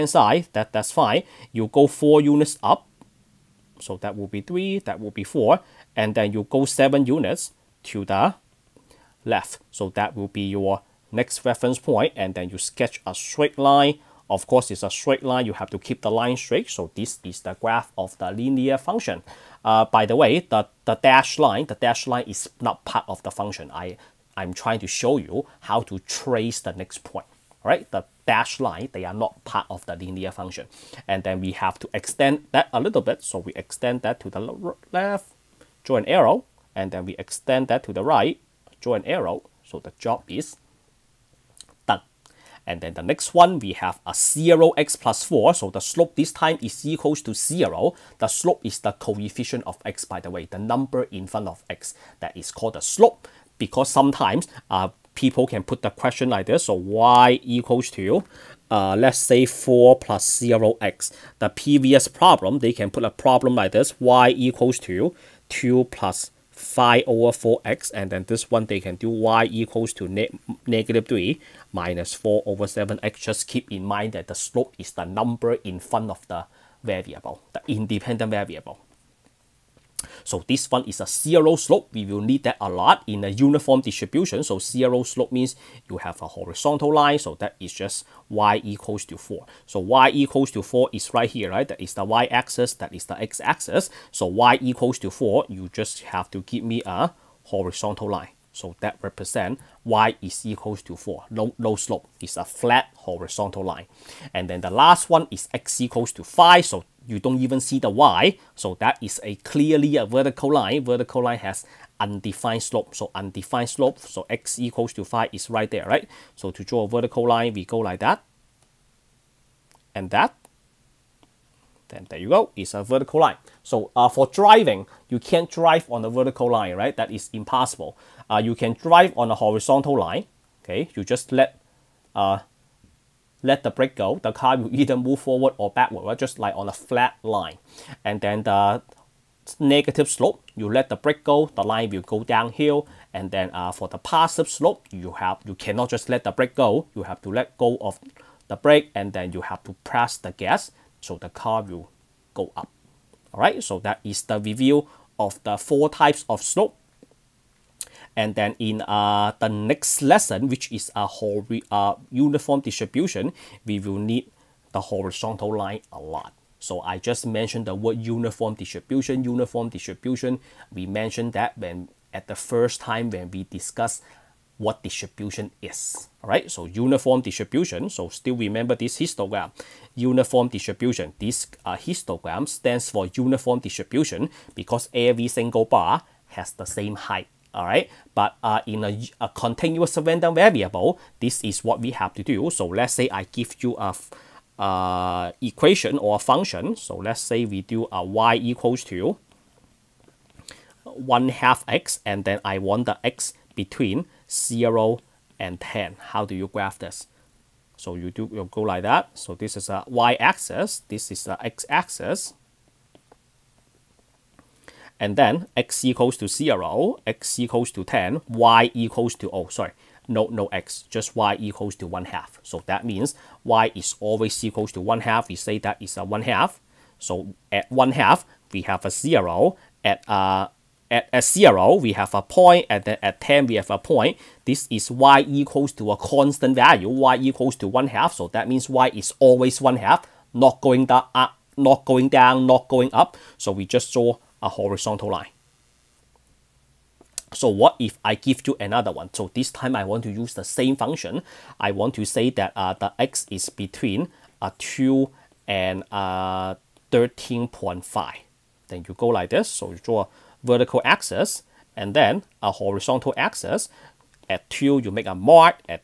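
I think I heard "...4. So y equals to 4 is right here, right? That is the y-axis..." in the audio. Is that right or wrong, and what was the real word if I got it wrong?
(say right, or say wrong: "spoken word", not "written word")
right.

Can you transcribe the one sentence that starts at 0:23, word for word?
I, I'm trying to show you how to trace the next point.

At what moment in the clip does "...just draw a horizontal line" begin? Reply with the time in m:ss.
4:03.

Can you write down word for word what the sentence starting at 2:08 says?
Uh, you can drive on a horizontal line, okay?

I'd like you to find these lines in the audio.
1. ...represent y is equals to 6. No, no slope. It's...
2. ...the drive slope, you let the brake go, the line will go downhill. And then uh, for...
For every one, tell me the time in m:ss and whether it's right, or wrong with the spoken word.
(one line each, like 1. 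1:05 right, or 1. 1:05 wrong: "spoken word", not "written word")
1. 1:39 wrong: "4", not "6"
2. 2:18 wrong: "negative", not "drive".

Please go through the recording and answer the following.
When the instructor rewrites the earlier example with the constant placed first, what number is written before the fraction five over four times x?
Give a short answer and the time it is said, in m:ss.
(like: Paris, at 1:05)
2, at 1:03.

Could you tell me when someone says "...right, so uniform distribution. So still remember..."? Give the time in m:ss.
2:56.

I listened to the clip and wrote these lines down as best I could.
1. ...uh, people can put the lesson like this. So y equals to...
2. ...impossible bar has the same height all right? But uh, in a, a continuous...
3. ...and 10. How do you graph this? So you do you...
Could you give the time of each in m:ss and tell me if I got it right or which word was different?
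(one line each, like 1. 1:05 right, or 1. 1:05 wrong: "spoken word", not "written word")
1. 0:54 wrong: "question", not "lesson"
2. 3:05 wrong: "single", not "impossible"
3. 3:25 right.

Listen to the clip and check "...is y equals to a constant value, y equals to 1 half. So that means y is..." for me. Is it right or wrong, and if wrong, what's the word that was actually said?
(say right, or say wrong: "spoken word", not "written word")
right.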